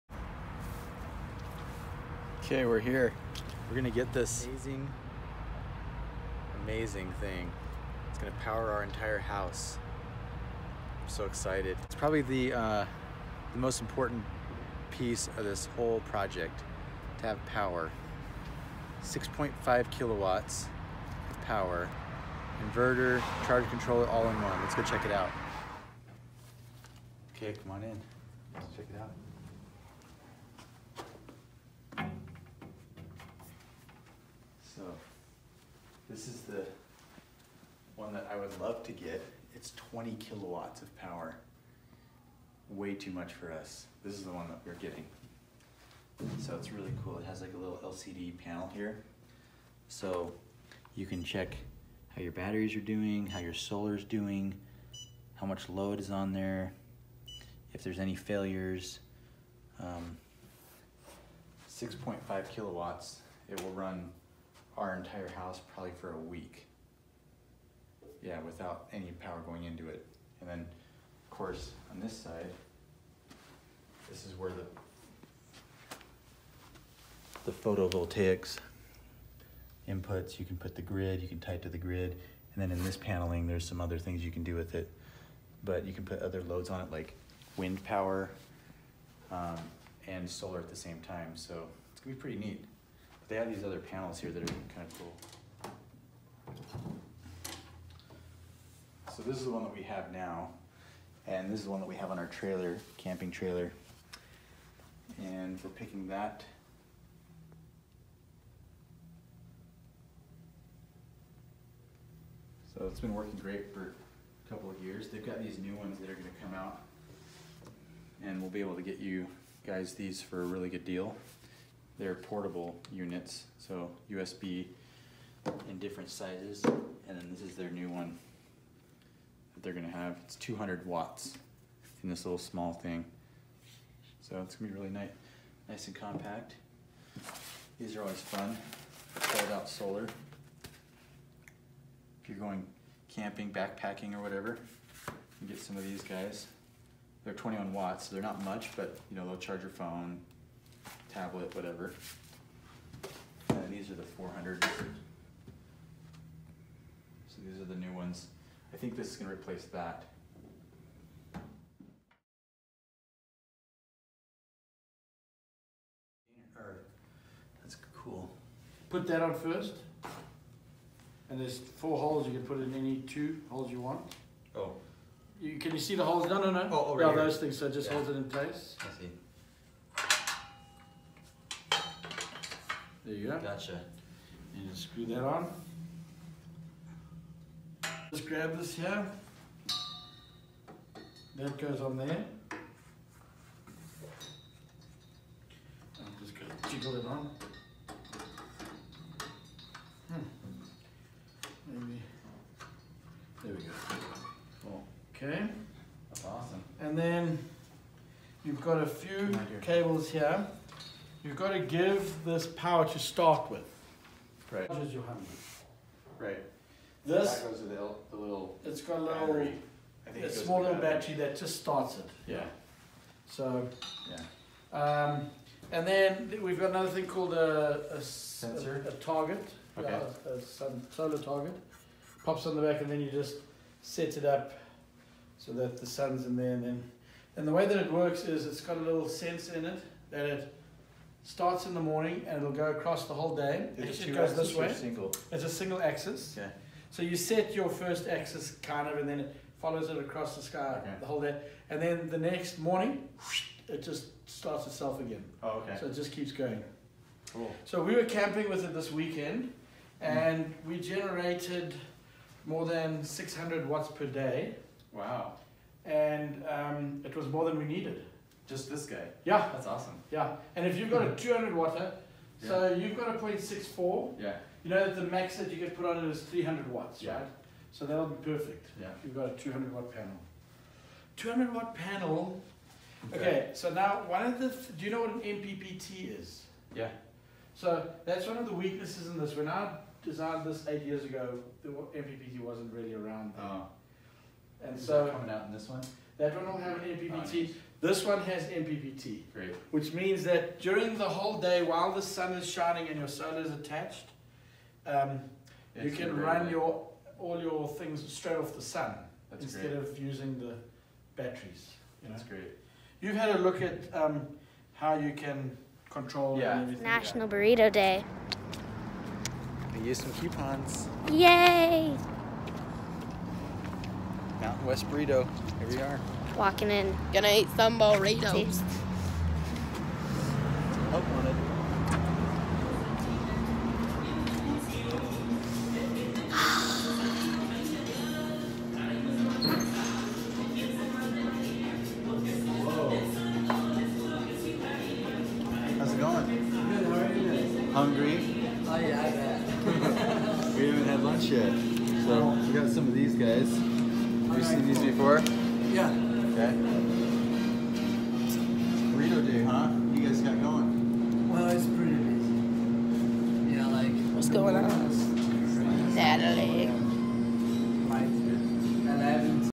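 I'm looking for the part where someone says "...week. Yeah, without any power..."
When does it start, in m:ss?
1:06.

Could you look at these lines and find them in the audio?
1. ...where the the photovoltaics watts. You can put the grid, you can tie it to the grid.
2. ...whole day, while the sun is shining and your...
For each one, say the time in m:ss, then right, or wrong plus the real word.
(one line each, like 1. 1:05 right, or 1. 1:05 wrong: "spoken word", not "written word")
1. 1:14 wrong: "inputs", not "watts"
2. 5:01 right.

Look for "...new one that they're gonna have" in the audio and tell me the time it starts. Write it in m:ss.
2:07.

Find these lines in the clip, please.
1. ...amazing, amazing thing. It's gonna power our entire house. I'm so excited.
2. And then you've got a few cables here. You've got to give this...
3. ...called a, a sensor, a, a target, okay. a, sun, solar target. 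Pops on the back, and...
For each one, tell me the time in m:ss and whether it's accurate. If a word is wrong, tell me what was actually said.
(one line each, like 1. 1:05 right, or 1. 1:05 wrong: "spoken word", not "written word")
1. 0:04 right
2. 3:26 right
3. 3:47 right.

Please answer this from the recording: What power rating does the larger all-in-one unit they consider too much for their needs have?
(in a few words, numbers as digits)
20 kilowatts.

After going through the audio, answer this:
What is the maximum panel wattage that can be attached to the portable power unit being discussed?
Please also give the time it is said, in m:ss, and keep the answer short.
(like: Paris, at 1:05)
300 watts, at 4:36.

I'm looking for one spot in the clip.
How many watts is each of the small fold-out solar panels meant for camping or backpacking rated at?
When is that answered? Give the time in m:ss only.
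2:27.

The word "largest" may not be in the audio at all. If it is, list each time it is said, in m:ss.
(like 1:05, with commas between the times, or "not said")
not said.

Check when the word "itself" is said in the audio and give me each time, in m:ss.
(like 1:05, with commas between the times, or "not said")
4:14.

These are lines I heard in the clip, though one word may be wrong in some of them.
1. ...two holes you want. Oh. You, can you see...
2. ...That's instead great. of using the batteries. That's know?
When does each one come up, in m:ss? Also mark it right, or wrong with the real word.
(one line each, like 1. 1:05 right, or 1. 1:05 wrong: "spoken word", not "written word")
1. 2:52 right
2. 5:09 right.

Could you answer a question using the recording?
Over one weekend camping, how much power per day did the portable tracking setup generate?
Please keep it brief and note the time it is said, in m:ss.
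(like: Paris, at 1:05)
more than 600 watts, at 4:22.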